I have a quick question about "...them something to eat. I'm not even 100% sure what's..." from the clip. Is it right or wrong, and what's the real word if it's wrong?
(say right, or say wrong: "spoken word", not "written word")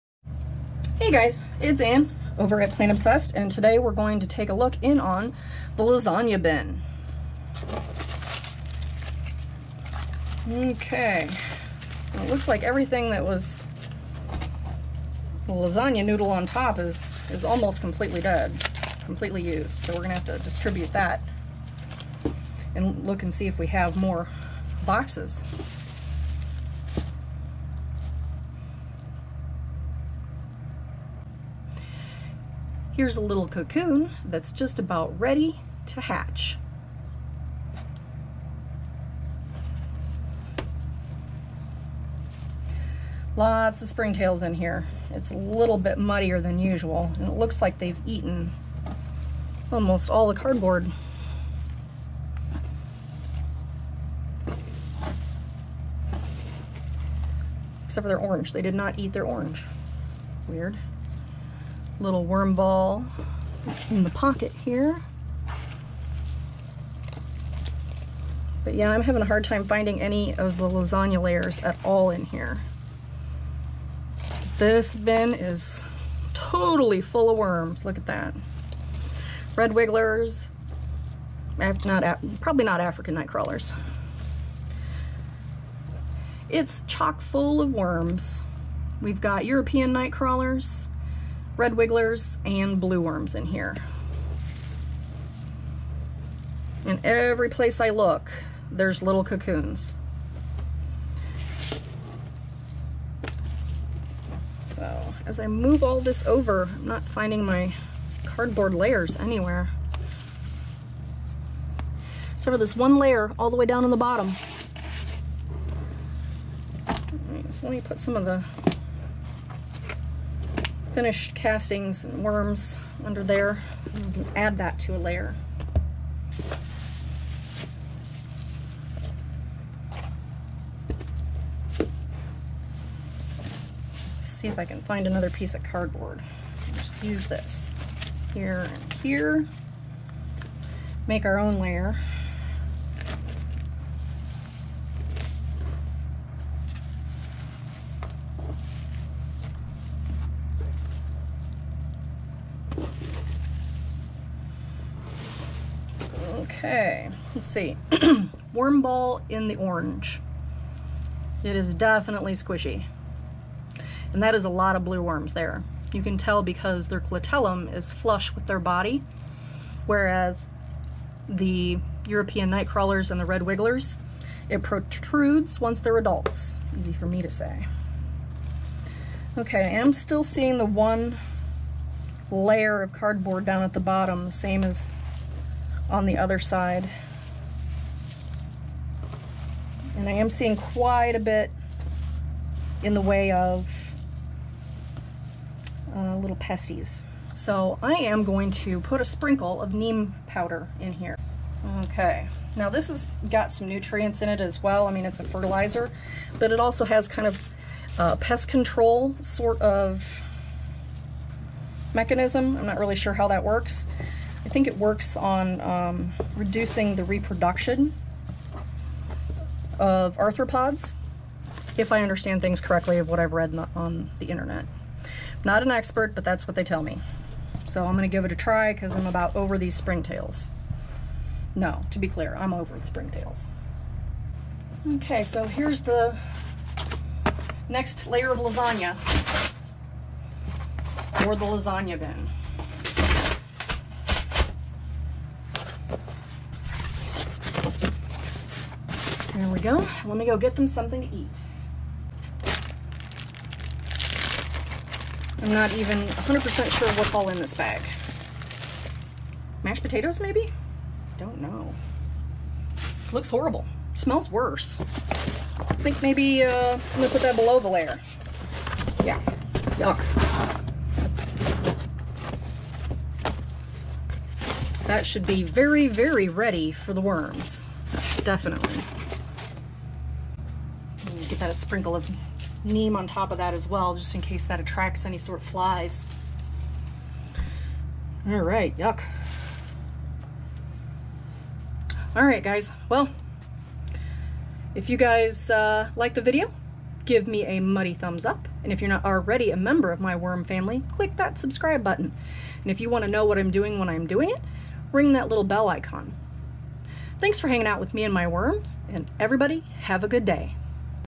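right.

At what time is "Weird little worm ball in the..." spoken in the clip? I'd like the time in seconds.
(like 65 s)
60 s.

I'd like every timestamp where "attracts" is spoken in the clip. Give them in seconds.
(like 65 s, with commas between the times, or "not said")
284 s.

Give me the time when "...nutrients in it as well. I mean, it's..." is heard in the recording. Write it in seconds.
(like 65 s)
203 s.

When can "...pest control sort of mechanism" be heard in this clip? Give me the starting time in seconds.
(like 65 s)
208 s.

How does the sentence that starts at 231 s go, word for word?
No, to be clear, I'm over the springtails.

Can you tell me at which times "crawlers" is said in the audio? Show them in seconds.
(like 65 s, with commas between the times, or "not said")
83 s, 90 s, 172 s.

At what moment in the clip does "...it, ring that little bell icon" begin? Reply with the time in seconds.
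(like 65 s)
304 s.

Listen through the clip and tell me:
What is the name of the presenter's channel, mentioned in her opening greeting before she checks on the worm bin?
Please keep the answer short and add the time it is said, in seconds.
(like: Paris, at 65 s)
Plant Obsessed, at 2 s.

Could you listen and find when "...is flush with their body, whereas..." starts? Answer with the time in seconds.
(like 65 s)
167 s.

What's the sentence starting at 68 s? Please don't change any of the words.
But yeah, I'm having a hard time finding any of the lasagna layers at all in here.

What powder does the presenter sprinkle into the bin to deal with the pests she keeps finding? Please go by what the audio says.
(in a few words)
neem powder.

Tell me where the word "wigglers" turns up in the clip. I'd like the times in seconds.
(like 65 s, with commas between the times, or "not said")
79 s, 91 s, 173 s.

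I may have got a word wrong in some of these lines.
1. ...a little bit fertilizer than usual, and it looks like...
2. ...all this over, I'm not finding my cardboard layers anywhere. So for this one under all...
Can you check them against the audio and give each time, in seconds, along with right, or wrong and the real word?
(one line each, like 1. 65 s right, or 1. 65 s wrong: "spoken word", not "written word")
1. 45 s wrong: "muddier", not "fertilizer"
2. 105 s wrong: "layer", not "under".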